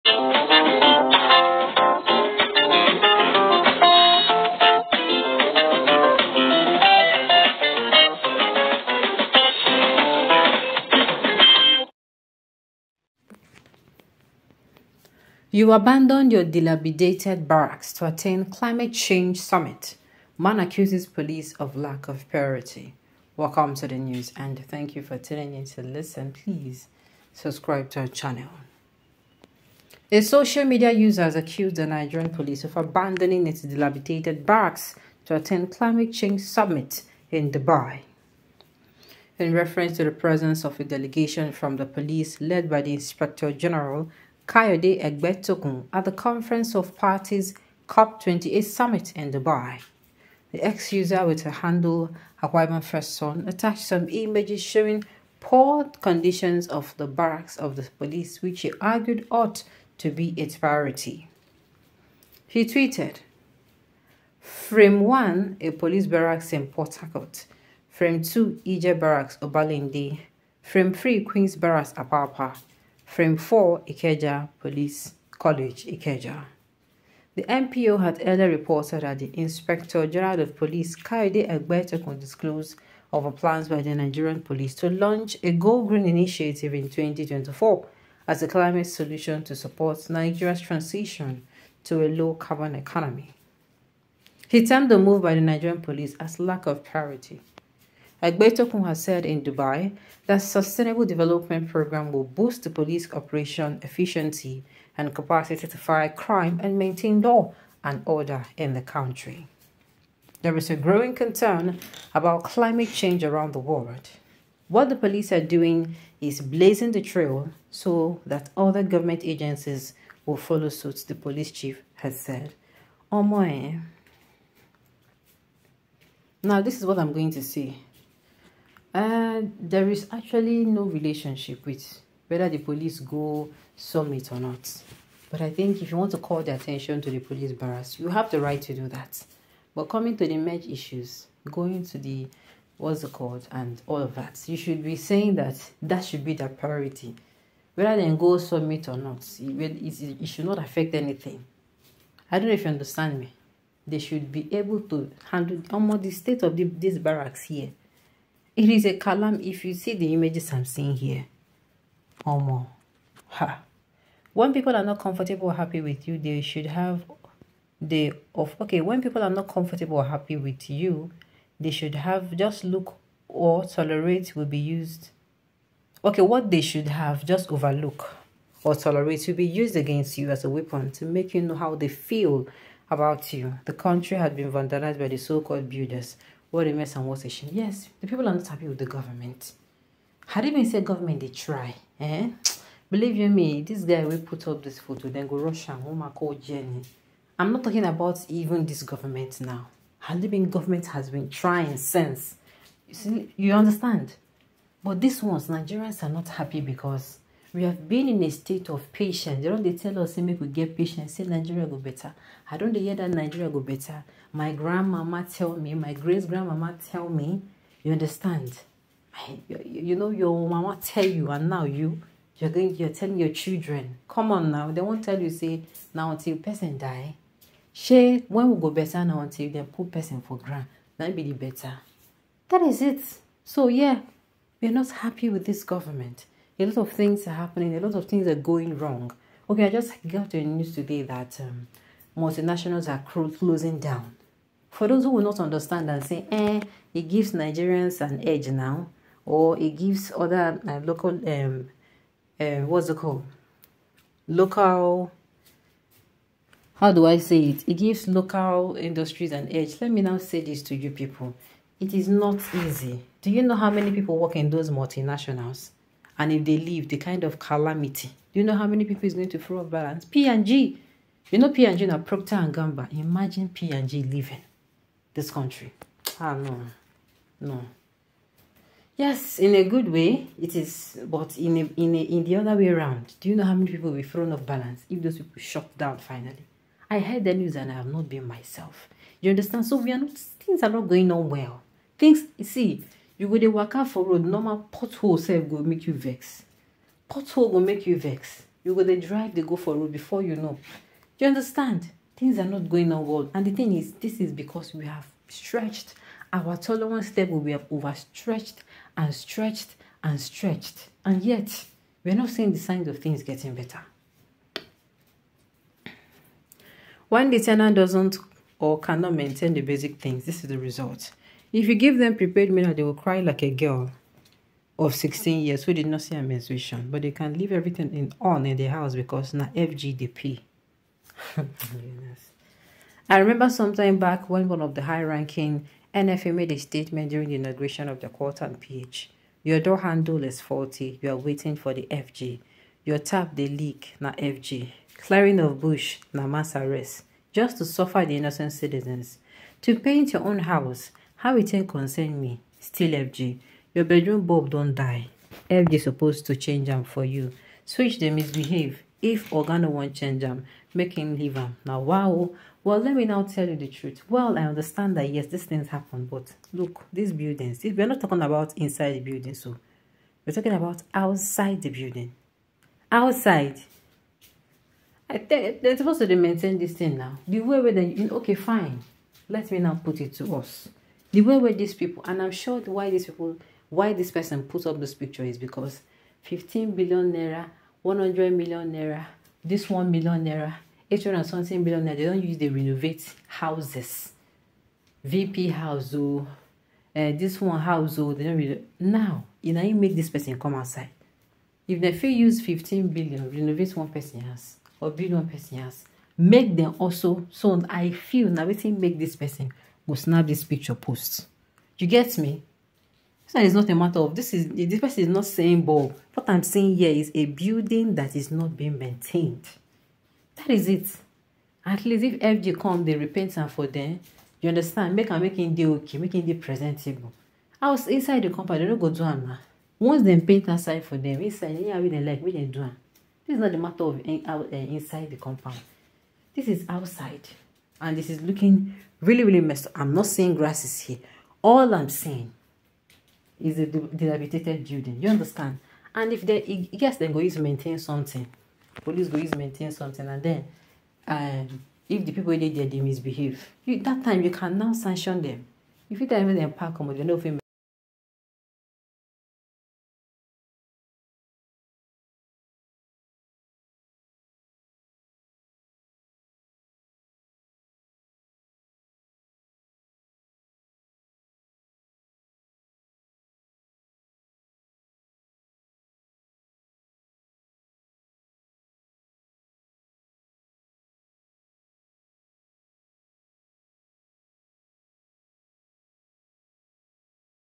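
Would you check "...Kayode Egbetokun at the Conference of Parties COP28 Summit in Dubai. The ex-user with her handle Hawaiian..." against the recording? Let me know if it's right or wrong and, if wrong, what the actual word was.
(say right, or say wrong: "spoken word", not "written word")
right.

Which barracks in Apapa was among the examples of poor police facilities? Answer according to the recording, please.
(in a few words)
Queen's Barracks.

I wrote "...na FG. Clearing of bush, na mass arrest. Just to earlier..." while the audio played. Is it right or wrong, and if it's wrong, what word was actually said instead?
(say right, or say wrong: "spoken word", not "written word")
wrong: "suffer", not "earlier".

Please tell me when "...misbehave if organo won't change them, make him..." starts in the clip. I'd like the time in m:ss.
5:58.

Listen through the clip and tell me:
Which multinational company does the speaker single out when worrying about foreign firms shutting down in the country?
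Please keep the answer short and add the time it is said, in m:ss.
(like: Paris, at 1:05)
Procter and Gamble, at 4:31.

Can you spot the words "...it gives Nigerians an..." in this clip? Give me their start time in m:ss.
4:06.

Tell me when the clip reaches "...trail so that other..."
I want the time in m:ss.
1:57.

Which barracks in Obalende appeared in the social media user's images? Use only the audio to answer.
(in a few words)
Ije Barracks.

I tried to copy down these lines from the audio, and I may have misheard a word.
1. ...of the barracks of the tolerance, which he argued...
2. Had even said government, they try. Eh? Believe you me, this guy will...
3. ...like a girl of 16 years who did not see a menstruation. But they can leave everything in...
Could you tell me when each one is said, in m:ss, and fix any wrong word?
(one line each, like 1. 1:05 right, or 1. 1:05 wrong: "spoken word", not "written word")
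1. 0:56 wrong: "police", not "tolerance"
2. 3:10 right
3. 5:23 right.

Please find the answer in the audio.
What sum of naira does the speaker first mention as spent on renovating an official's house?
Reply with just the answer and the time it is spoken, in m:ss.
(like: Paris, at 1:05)
15 billion naira, at 6:26.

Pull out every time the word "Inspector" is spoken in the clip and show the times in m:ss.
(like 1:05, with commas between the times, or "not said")
0:42, 1:19.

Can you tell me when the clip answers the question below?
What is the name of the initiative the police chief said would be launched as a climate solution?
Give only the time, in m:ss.
1:25.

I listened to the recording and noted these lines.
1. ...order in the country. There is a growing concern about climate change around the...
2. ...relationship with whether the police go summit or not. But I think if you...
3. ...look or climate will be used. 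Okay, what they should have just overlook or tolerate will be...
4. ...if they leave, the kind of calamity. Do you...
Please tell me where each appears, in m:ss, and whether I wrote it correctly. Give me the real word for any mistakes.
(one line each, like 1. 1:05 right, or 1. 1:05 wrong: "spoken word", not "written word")
1. 1:48 right
2. 2:10 right
3. 2:52 wrong: "tolerate", not "climate"
4. 4:26 right.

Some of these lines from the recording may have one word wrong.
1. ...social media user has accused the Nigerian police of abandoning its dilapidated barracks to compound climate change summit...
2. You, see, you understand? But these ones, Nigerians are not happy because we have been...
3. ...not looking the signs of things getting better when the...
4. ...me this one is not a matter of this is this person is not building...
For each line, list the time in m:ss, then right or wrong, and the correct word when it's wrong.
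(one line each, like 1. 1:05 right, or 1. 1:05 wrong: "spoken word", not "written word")
1. 0:30 wrong: "attend", not "compound"
2. 3:22 right
3. 5:12 wrong: "seeing", not "looking"
4. 6:52 wrong: "saying", not "building".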